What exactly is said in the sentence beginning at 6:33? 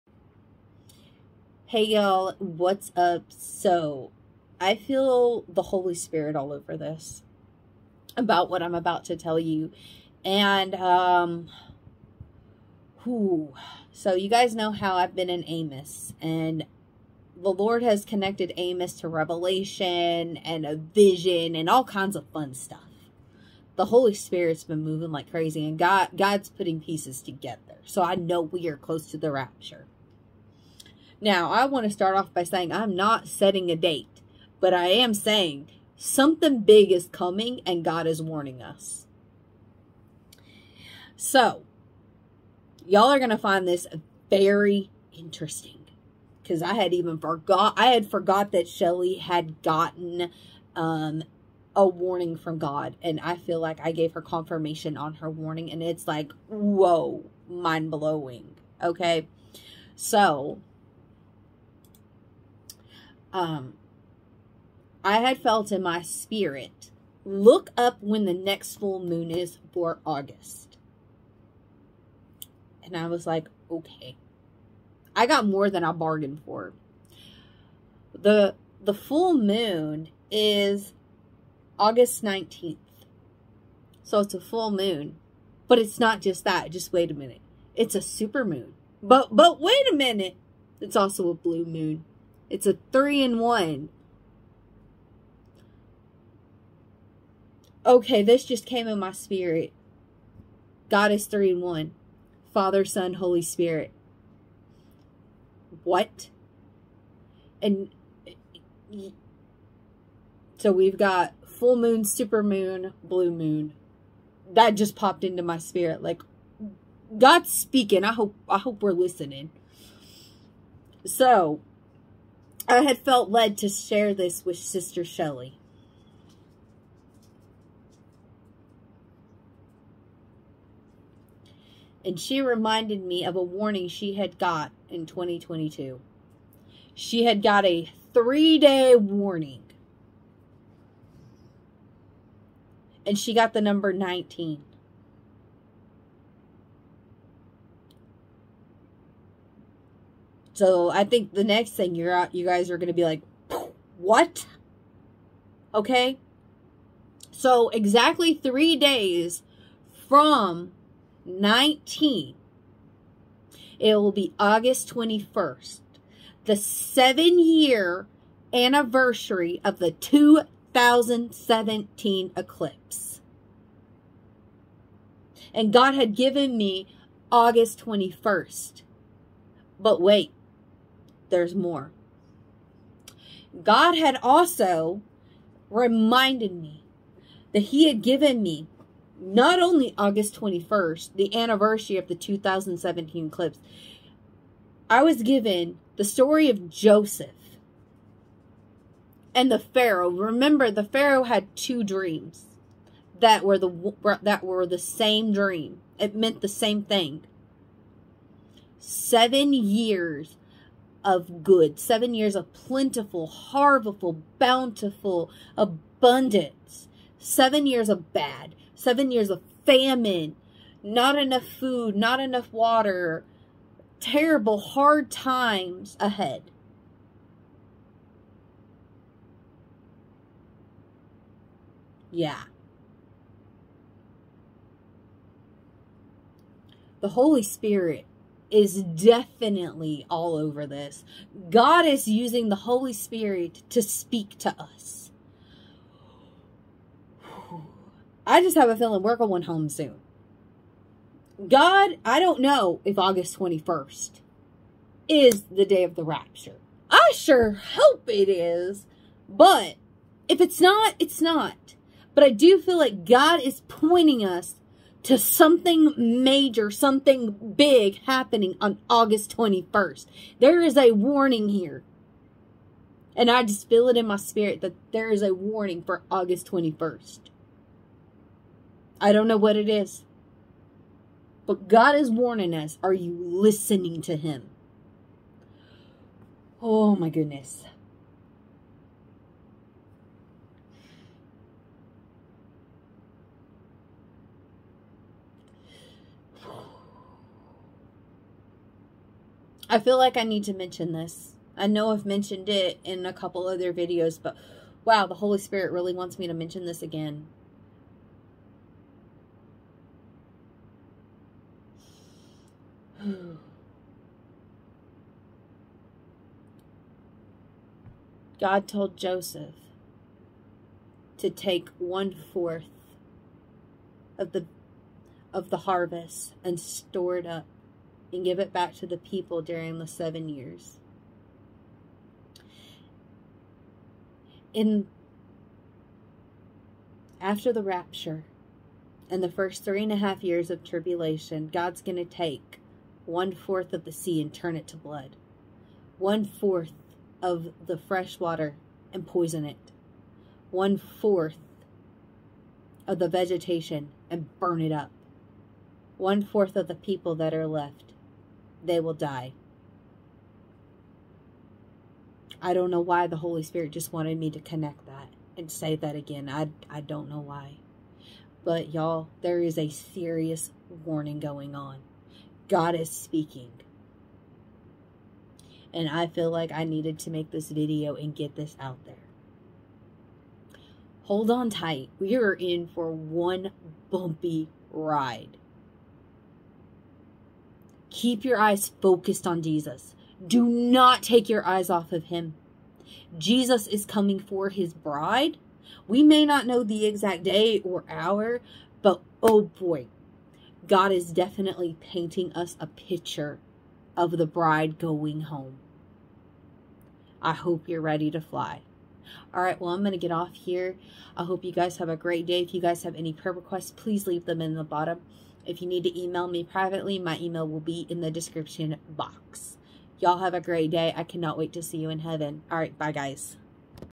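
Jesus is coming for his bride.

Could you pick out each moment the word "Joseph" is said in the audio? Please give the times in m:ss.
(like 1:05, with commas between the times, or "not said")
3:16, 5:18.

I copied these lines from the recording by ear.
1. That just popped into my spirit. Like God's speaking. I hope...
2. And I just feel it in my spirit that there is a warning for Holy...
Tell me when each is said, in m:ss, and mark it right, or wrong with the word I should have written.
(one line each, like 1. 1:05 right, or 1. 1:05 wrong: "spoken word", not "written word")
1. 1:54 right
2. 4:33 wrong: "August", not "Holy".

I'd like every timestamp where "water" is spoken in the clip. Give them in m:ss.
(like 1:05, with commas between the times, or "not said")
3:42, 5:48.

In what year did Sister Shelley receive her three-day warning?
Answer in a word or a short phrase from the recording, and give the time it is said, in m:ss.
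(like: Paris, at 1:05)
2022, at 2:15.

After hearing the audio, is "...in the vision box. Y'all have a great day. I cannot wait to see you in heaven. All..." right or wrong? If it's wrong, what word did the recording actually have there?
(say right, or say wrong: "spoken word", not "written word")
wrong: "description", not "vision".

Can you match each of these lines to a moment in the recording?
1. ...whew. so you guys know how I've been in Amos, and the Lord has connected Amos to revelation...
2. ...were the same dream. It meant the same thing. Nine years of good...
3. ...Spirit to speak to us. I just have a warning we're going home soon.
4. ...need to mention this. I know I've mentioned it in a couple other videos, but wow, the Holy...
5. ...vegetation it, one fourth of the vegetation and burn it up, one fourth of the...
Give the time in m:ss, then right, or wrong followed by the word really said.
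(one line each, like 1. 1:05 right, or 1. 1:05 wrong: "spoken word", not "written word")
1. 0:13 right
2. 3:24 wrong: "Seven", not "Nine"
3. 4:02 wrong: "feeling", not "warning"
4. 5:00 right
5. 5:49 wrong: "poison", not "vegetation".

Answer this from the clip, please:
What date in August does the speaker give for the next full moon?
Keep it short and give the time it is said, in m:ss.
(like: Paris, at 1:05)
August 19th, at 1:21.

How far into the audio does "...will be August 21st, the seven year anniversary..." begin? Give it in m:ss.
2:43.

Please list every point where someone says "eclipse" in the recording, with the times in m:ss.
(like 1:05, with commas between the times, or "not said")
2:52, 3:13.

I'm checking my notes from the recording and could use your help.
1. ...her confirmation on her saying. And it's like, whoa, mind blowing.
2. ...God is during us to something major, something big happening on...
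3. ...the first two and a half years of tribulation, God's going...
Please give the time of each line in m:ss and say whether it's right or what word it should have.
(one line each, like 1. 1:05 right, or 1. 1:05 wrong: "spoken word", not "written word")
1. 0:54 wrong: "warning", not "saying"
2. 4:23 wrong: "pointing", not "during"
3. 5:39 wrong: "three", not "two".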